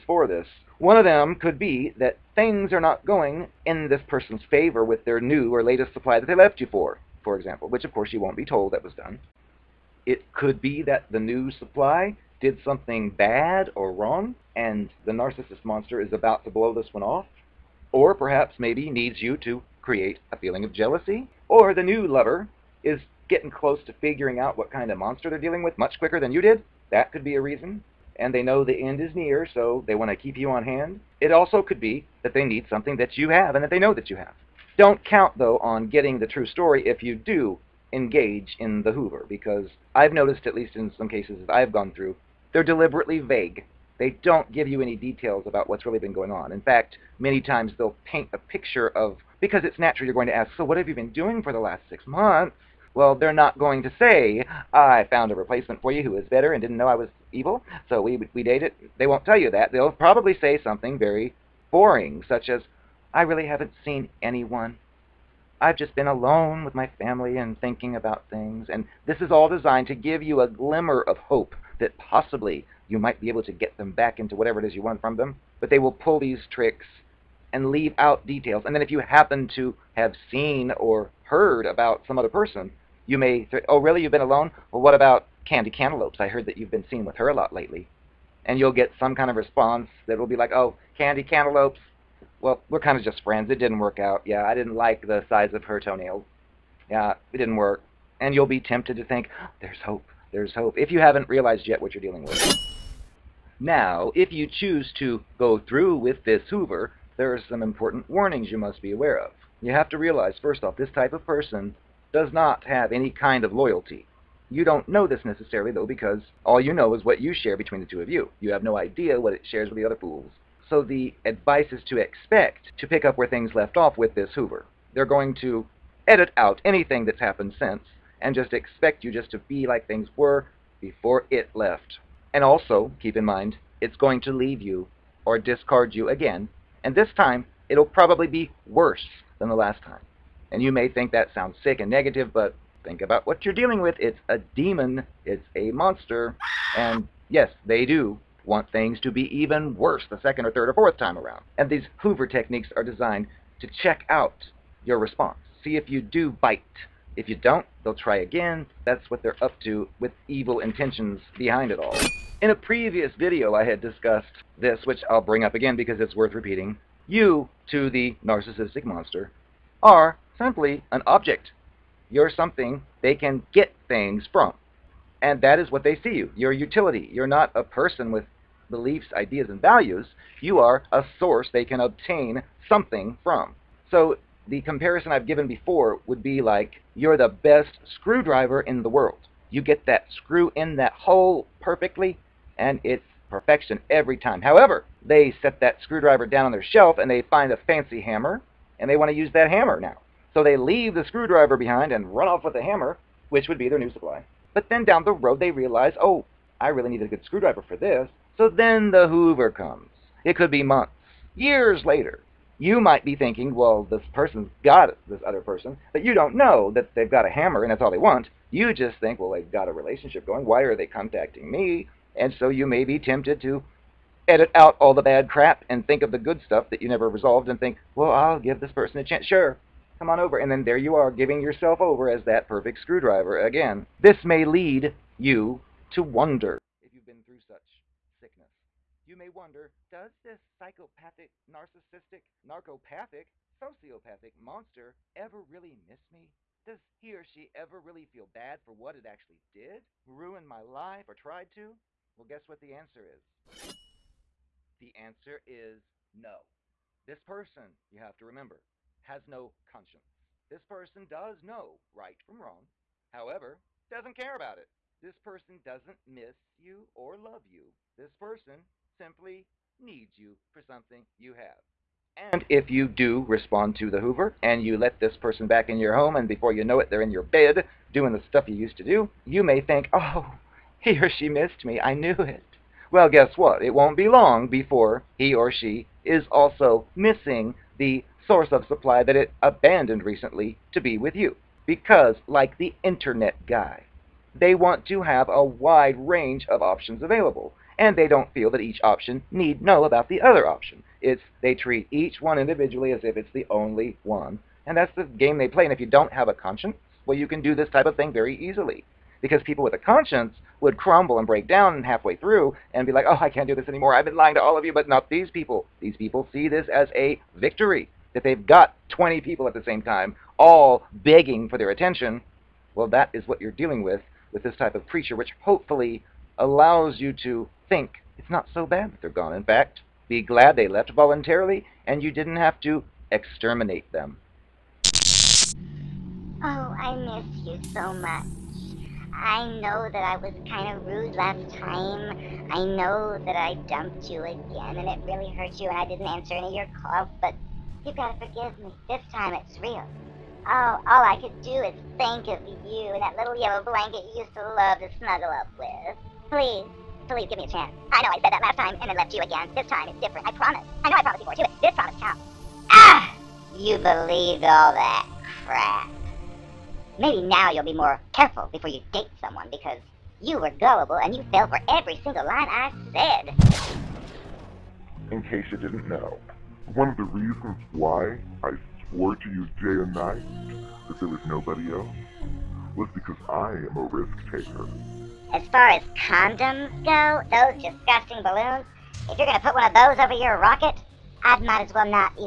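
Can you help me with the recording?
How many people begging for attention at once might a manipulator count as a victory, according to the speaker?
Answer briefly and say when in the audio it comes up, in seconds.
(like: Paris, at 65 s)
20, at 318 s.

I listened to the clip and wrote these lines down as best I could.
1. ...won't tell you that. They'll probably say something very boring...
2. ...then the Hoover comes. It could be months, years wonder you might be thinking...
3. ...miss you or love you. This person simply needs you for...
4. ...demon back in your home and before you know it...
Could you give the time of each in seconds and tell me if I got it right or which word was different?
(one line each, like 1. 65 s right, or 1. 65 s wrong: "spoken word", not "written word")
1. 59 s right
2. 208 s wrong: "later", not "wonder"
3. 266 s right
4. 275 s wrong: "person", not "demon".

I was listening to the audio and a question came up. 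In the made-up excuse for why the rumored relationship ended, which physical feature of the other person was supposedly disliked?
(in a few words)
Toenails.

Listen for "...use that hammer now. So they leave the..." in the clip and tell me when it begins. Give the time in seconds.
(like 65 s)
199 s.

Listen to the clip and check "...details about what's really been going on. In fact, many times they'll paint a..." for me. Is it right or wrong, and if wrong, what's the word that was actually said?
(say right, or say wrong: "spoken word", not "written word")
right.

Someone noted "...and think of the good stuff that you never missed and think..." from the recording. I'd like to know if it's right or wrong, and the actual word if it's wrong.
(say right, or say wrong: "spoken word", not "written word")
wrong: "resolved", not "missed".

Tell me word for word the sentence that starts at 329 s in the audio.
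In fact, be glad they left voluntarily and you didn't have to exterminate them.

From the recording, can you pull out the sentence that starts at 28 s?
And they know the end is near, so they want to keep you on hand.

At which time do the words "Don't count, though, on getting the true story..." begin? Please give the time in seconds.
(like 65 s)
34 s.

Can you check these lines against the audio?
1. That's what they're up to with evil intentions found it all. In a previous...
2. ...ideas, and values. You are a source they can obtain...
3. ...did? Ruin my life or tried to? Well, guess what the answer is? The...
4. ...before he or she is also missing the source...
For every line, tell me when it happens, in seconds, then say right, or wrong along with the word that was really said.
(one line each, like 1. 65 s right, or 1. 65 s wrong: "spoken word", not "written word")
1. 158 s wrong: "behind", not "found"
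2. 179 s right
3. 249 s right
4. 284 s right.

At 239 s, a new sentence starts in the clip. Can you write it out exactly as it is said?
You may wonder, does this psychopathic, narcissistic, narcopathic, sociopathic monster ever really miss me?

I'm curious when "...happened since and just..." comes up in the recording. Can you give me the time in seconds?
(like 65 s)
127 s.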